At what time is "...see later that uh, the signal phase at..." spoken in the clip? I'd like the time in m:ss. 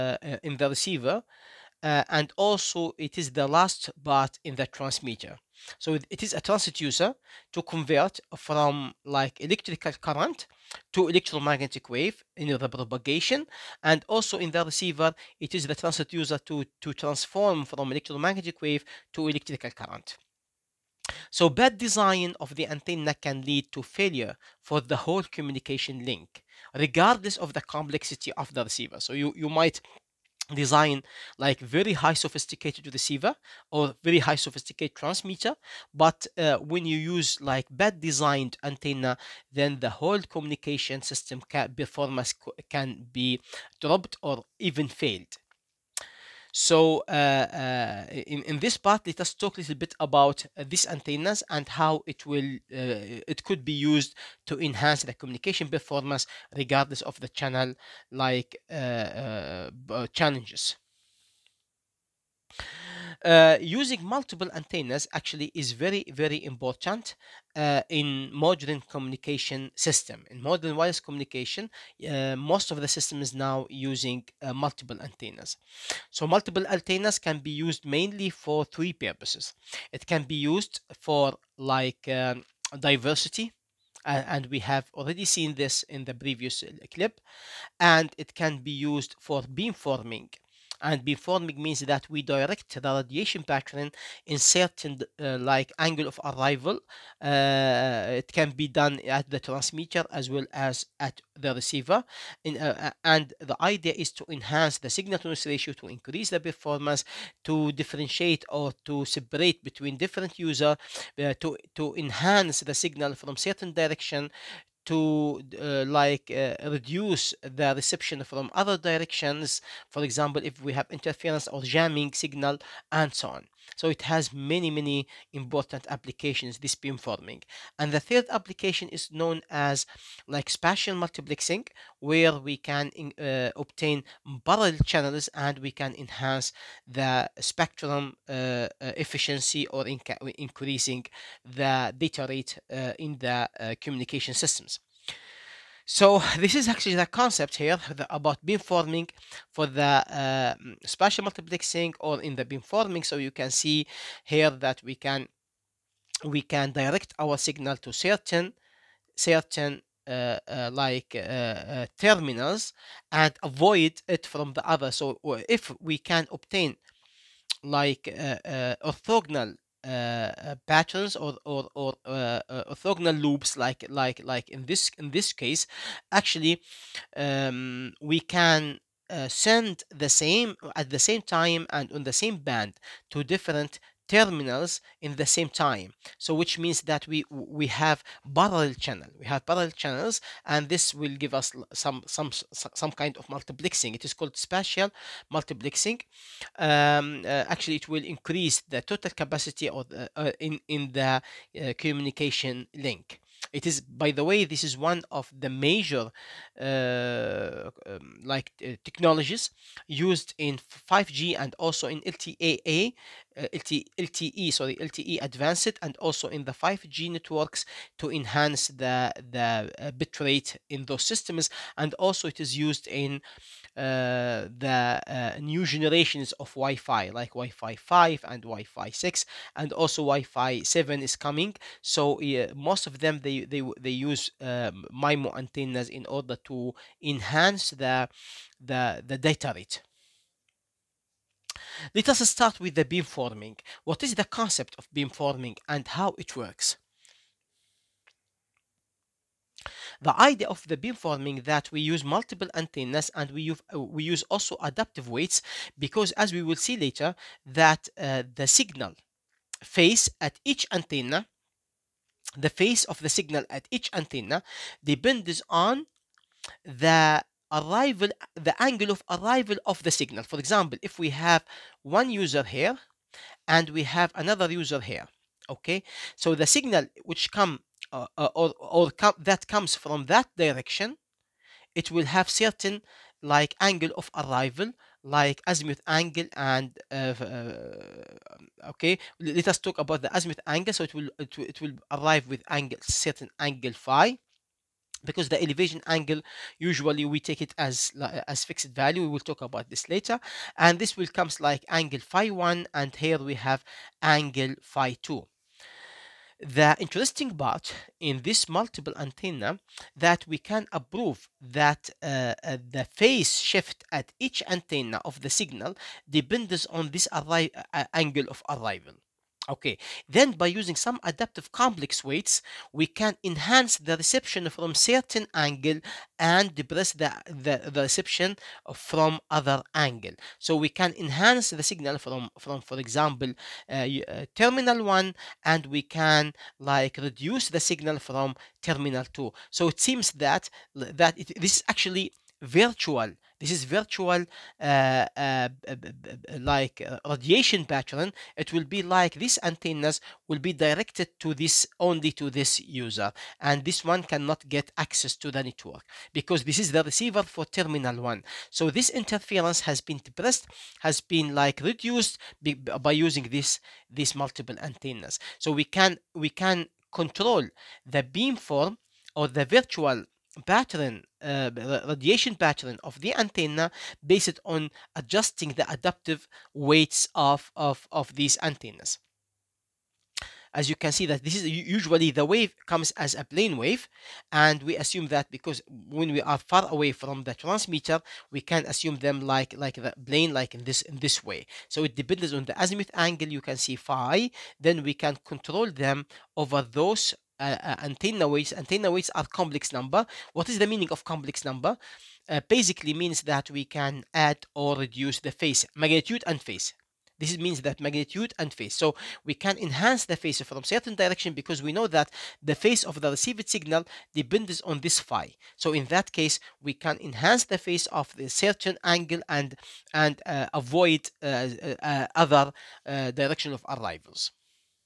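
4:16.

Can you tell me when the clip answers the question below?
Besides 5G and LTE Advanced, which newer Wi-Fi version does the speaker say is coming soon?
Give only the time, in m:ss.
3:50.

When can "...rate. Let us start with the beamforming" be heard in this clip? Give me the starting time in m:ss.
3:59.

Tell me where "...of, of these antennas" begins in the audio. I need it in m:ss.
6:17.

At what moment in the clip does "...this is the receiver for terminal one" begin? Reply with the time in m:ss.
5:56.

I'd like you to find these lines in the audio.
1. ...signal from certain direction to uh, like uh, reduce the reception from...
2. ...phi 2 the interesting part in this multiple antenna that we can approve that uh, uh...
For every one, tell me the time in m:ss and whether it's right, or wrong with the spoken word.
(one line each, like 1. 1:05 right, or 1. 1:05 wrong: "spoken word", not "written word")
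1. 1:52 right
2. 5:04 right.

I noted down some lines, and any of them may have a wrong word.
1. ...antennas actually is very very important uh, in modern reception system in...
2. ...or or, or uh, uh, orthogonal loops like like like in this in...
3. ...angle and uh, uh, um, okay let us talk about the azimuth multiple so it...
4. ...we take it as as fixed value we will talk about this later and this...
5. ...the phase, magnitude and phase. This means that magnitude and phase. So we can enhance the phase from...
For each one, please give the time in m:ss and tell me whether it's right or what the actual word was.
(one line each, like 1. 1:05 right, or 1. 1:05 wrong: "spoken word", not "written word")
1. 1:04 wrong: "communication", not "reception"
2. 2:51 right
3. 4:45 wrong: "angle", not "multiple"
4. 4:57 right
5. 6:45 right.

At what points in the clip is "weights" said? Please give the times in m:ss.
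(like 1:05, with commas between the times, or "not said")
4:15, 5:22, 6:16.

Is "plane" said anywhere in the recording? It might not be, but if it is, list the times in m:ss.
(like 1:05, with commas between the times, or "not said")
6:23, 6:30.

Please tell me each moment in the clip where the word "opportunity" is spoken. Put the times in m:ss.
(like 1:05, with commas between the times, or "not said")
not said.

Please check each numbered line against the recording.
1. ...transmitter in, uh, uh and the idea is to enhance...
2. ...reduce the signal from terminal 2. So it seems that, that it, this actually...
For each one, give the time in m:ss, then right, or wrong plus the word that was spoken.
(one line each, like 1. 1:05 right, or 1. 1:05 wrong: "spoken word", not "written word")
1. 1:41 wrong: "receiver", not "transmitter"
2. 5:36 right.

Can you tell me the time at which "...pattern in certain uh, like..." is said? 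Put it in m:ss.
1:33.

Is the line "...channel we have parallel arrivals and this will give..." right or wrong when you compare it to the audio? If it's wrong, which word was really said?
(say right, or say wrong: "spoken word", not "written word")
wrong: "channels", not "arrivals".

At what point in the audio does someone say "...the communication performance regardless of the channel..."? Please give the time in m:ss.
0:55.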